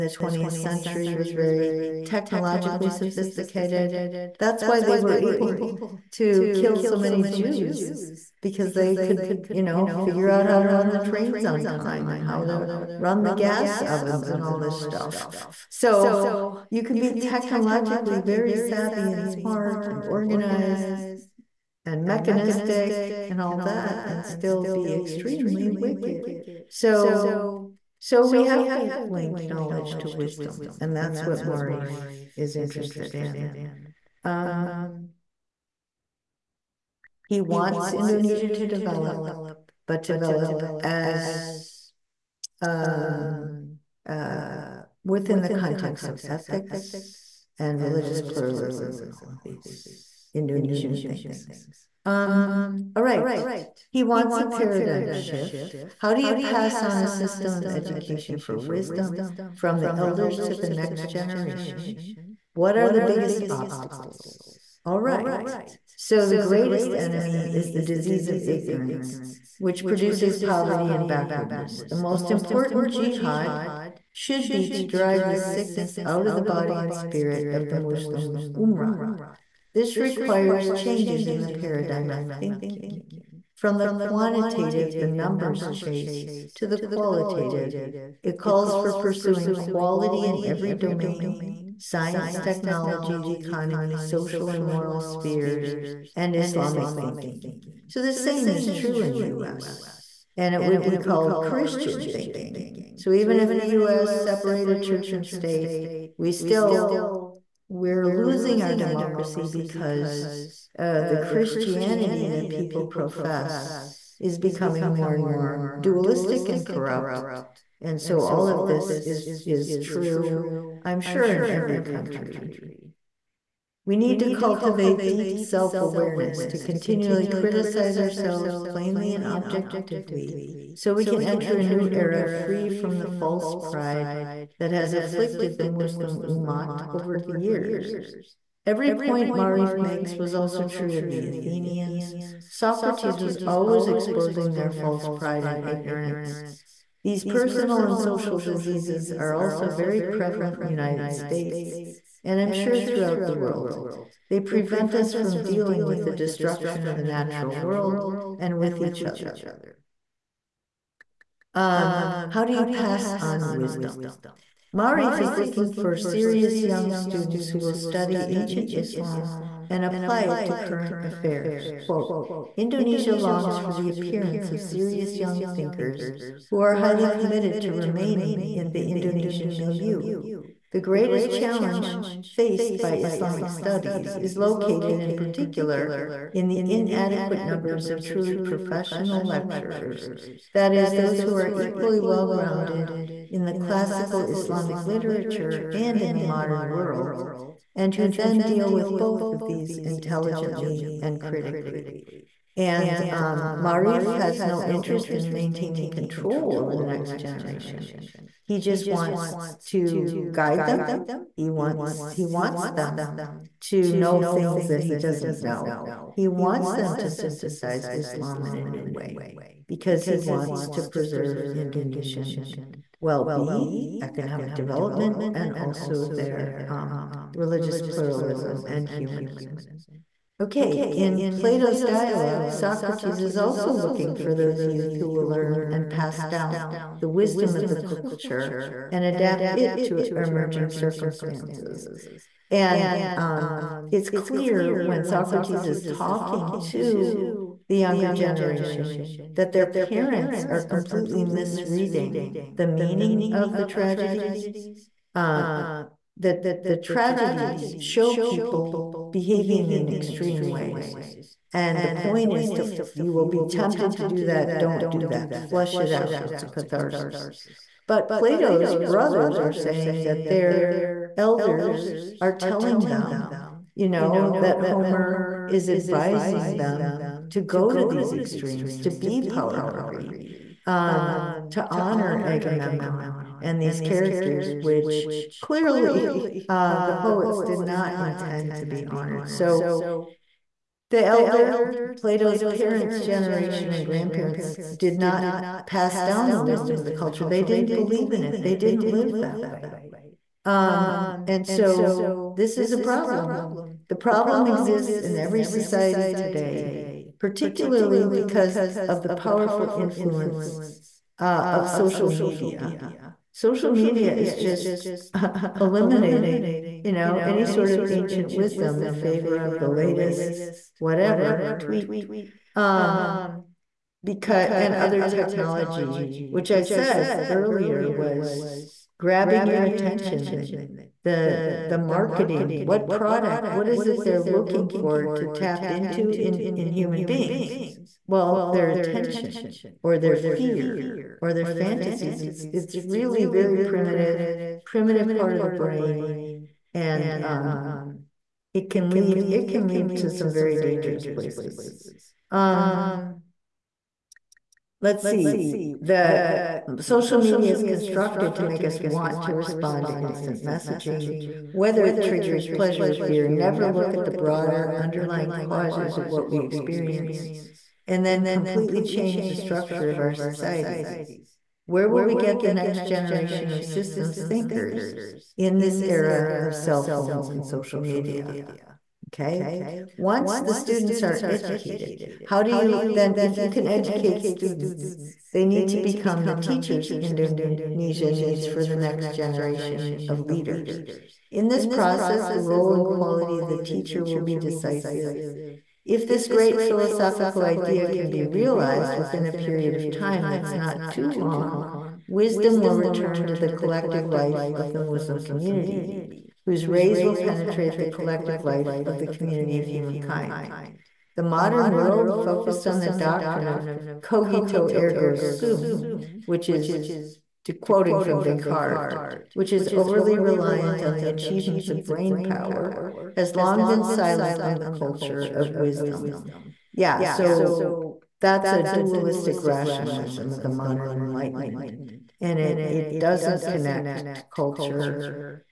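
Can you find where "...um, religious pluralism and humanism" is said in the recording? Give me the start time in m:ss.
3:46.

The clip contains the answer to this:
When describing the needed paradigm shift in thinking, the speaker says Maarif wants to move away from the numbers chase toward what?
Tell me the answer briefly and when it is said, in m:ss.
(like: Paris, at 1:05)
The qualitative, at 1:26.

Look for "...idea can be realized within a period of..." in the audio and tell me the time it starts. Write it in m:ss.
6:37.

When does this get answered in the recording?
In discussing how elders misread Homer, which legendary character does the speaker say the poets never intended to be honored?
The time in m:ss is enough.
4:42.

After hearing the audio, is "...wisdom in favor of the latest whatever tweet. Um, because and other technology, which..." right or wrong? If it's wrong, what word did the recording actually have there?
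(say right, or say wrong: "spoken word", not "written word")
right.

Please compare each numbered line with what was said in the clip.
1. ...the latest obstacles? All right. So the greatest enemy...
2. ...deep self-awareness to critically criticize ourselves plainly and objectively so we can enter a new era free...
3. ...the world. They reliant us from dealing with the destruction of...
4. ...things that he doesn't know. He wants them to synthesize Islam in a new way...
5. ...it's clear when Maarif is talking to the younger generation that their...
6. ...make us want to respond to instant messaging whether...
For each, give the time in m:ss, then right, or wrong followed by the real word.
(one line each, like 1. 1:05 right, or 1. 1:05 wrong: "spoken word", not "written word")
1. 1:02 wrong: "biggest", not "latest"
2. 2:05 wrong: "continually", not "critically"
3. 2:33 wrong: "prevent", not "reliant"
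4. 3:34 right
5. 4:03 wrong: "Socrates", not "Maarif"
6. 5:58 right.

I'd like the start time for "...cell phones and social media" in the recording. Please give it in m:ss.
6:16.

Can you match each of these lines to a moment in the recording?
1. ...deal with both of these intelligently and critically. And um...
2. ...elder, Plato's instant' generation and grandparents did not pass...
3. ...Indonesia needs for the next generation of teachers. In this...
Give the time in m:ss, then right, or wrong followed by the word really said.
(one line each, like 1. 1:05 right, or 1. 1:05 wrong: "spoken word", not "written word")
1. 3:18 right
2. 4:51 wrong: "parents", not "instant"
3. 6:27 wrong: "leaders", not "teachers".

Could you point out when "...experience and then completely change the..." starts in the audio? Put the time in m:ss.
6:06.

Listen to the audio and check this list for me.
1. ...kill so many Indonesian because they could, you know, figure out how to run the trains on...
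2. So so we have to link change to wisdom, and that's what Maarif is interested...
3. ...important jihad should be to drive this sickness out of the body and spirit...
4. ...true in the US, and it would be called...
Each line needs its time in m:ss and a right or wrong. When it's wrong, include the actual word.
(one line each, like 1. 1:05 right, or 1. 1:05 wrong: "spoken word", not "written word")
1. 0:06 wrong: "Jews", not "Indonesian"
2. 0:26 wrong: "knowledge", not "change"
3. 1:12 right
4. 1:38 right.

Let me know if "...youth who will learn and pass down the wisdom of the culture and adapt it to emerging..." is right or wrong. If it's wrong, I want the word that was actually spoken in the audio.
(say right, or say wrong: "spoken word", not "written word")
right.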